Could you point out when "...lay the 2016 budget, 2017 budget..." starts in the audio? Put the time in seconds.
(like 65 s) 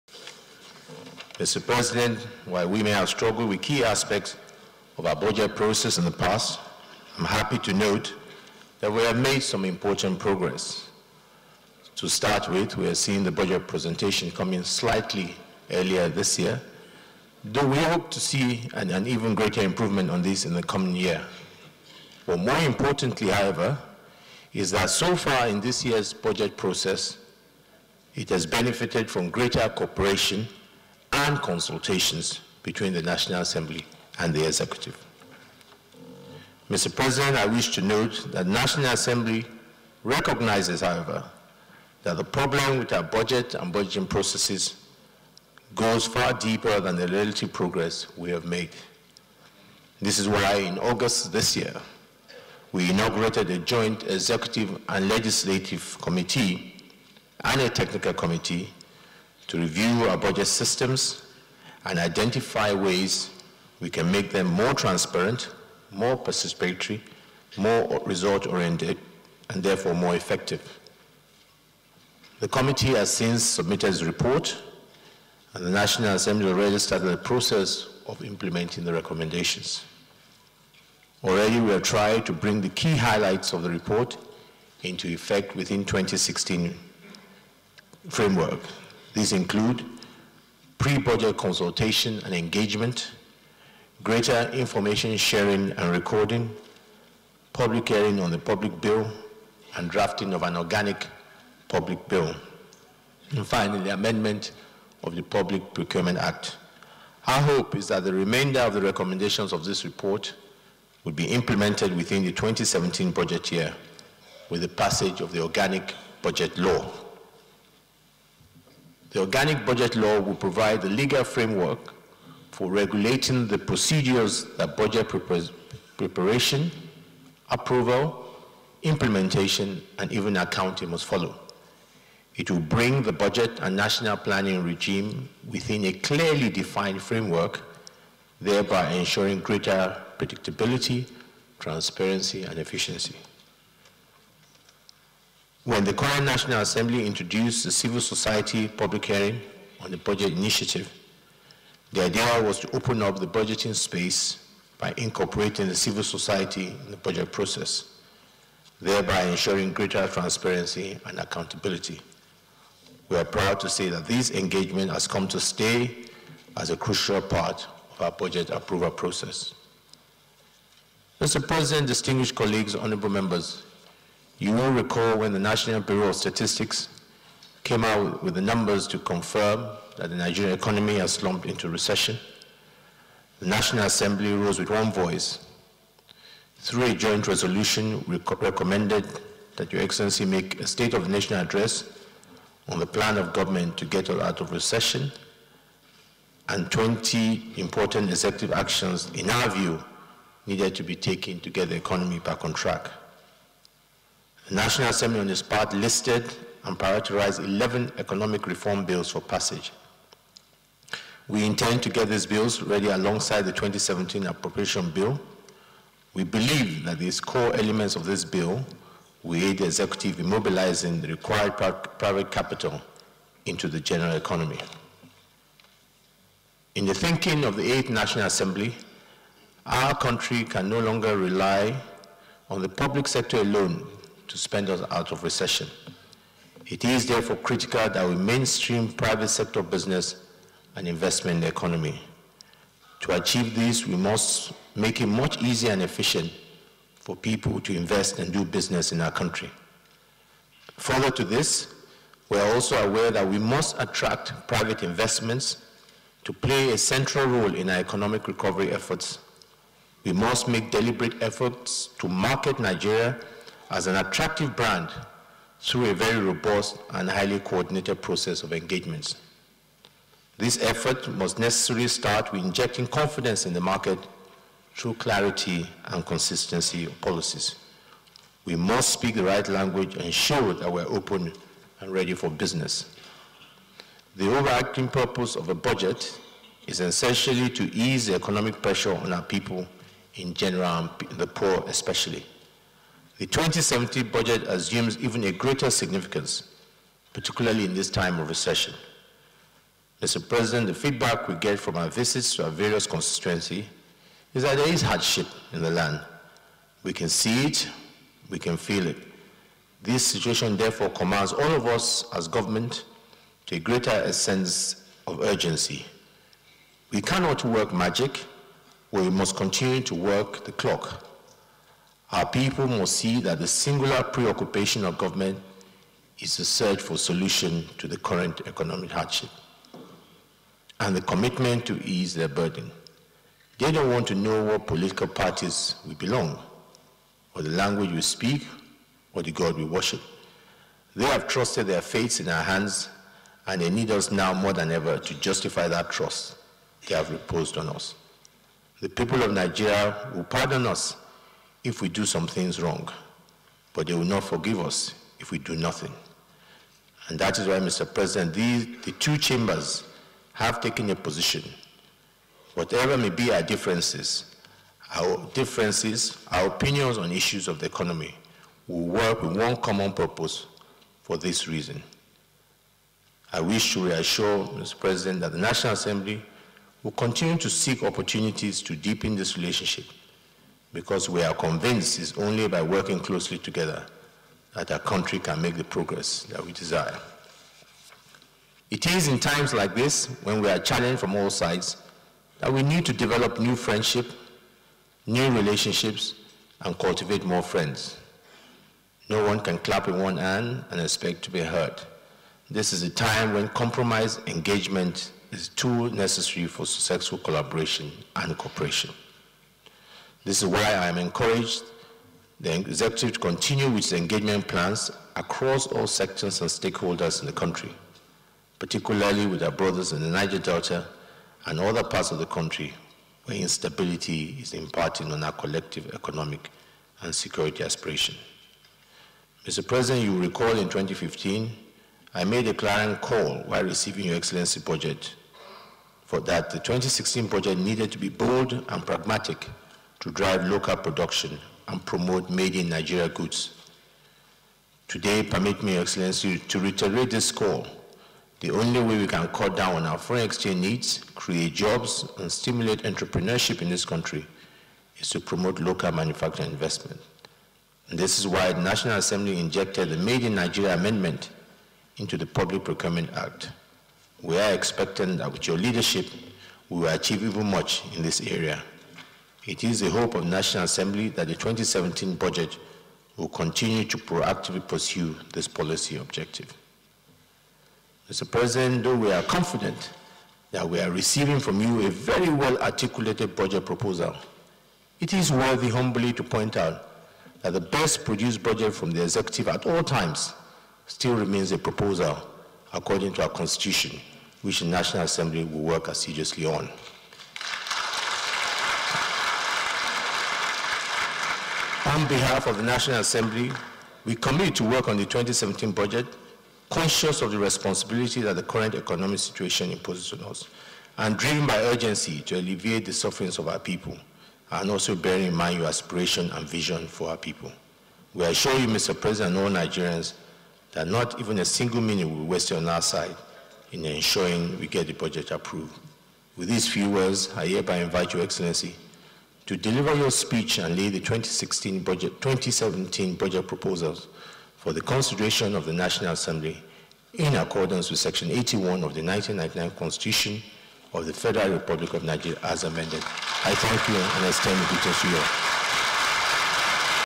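530 s.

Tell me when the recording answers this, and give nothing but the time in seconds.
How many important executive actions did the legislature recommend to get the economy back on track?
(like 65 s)
196 s.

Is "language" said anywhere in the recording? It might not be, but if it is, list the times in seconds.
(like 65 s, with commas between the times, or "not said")
279 s, 337 s.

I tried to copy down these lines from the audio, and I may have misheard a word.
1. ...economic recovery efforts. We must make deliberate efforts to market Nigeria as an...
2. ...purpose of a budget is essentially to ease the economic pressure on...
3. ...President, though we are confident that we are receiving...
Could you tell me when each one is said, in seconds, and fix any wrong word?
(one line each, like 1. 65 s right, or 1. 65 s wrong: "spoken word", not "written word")
1. 257 s right
2. 284 s right
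3. 478 s right.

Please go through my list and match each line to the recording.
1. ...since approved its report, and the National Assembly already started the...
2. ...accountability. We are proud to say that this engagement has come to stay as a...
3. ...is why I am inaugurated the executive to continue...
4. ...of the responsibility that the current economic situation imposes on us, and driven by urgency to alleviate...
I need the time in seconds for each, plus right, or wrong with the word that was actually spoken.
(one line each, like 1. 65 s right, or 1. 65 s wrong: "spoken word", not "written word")
1. 73 s wrong: "submitted", not "approved"
2. 161 s right
3. 410 s wrong: "encouraged", not "inaugurated"
4. 507 s right.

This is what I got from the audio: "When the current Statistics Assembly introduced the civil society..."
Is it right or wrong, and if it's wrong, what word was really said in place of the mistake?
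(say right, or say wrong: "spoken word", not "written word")
wrong: "National", not "Statistics".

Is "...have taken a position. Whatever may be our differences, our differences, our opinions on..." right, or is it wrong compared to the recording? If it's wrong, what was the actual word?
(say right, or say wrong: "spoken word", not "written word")
right.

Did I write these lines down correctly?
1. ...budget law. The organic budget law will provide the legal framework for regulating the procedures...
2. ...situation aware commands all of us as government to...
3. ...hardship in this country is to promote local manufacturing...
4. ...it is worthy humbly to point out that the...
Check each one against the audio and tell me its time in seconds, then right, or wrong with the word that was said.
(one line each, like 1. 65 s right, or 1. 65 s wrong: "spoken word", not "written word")
1. 116 s right
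2. 310 s wrong: "therefore", not "aware"
3. 452 s wrong: "entrepreneurship", not "hardship"
4. 484 s right.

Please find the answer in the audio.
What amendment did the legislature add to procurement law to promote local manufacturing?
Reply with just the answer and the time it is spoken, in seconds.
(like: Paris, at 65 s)
Made in Nigeria Amendment, at 459 s.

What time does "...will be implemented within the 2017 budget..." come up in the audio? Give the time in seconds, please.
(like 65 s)
111 s.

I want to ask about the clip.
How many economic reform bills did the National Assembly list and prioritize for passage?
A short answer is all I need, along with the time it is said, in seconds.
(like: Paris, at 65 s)
11, at 207 s.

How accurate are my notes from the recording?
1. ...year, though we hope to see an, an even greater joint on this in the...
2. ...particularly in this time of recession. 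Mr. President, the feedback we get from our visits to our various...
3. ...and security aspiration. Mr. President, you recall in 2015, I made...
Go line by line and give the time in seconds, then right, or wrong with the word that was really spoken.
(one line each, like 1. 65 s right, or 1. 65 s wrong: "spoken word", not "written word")
1. 16 s wrong: "improvement", not "joint"
2. 297 s right
3. 427 s right.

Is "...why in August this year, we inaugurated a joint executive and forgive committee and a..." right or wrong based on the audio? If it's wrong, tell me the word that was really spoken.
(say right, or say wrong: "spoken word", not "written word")
wrong: "legislative", not "forgive".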